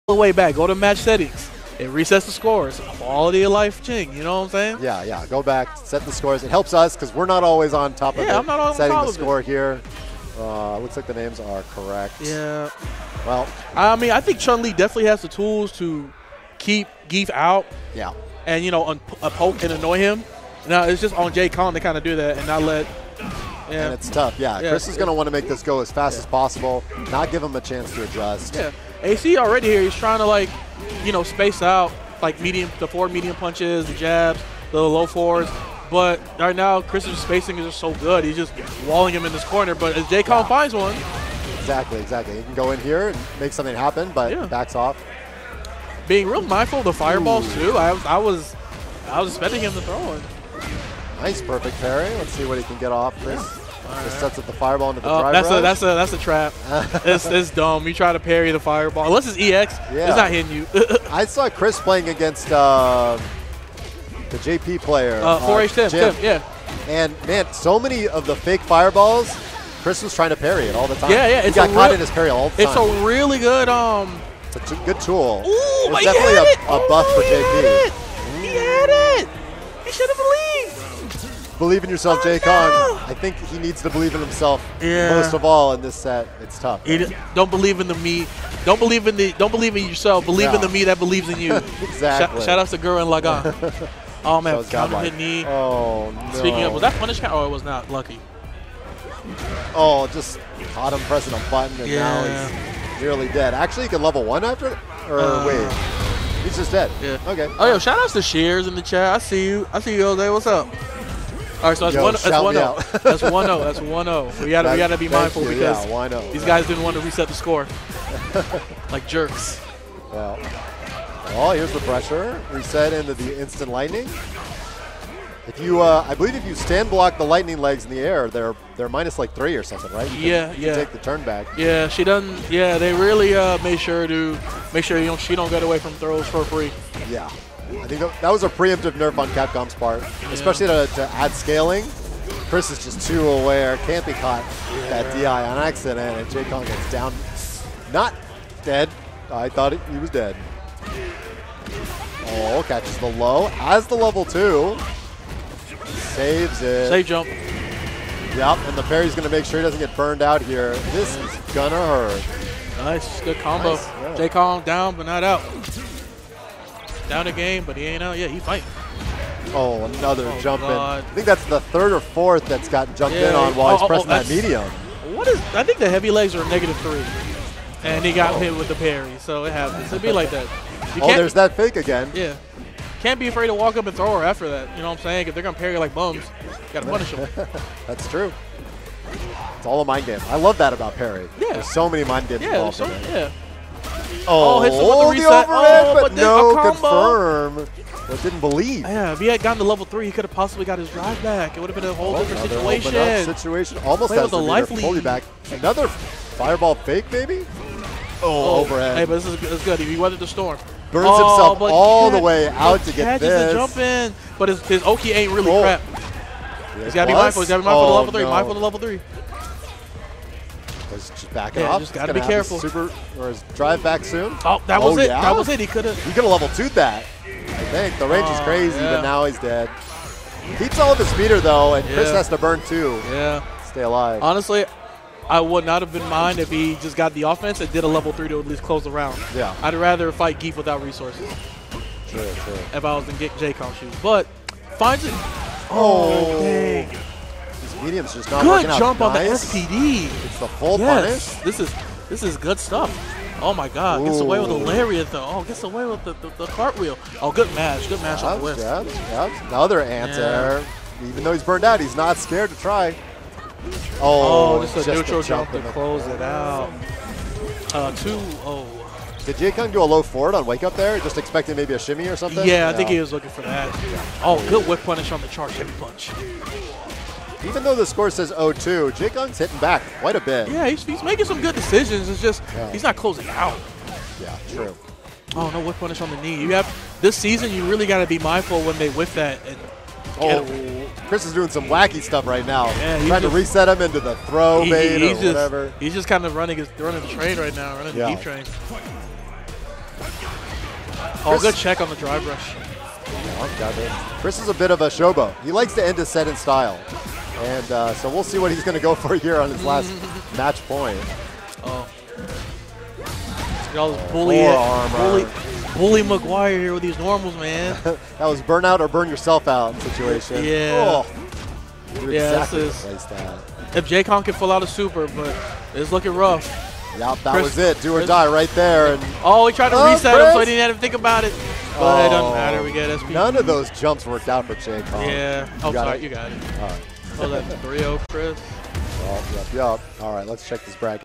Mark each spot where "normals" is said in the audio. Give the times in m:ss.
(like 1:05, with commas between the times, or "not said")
5:16.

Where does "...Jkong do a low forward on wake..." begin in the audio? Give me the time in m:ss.
4:29.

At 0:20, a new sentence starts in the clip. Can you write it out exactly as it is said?
Now, it's just on Jkong to kind of do that and not let yeah.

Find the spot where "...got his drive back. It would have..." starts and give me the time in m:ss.
3:20.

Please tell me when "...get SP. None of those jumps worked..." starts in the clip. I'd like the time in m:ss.
5:32.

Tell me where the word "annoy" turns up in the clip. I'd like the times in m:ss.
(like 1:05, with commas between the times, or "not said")
0:19.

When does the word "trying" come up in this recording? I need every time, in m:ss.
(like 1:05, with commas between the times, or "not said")
0:29, 1:10, 4:53.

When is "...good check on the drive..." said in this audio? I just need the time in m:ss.
5:01.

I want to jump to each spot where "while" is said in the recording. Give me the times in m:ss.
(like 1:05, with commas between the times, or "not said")
2:53.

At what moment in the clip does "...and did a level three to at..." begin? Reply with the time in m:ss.
3:57.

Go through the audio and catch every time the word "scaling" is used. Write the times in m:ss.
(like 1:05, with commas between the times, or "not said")
2:21.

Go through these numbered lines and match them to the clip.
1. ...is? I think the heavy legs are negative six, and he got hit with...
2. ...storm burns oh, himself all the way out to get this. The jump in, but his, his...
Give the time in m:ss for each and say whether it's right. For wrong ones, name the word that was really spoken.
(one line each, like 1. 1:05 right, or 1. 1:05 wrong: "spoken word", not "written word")
1. 2:55 wrong: "three", not "six"
2. 3:30 right.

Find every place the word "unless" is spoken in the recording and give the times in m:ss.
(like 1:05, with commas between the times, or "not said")
0:59.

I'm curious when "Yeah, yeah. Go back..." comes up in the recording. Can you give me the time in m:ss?
0:04.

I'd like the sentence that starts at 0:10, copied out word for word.
Uh, looks like the names are correct.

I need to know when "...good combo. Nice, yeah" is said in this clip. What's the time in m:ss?
2:43.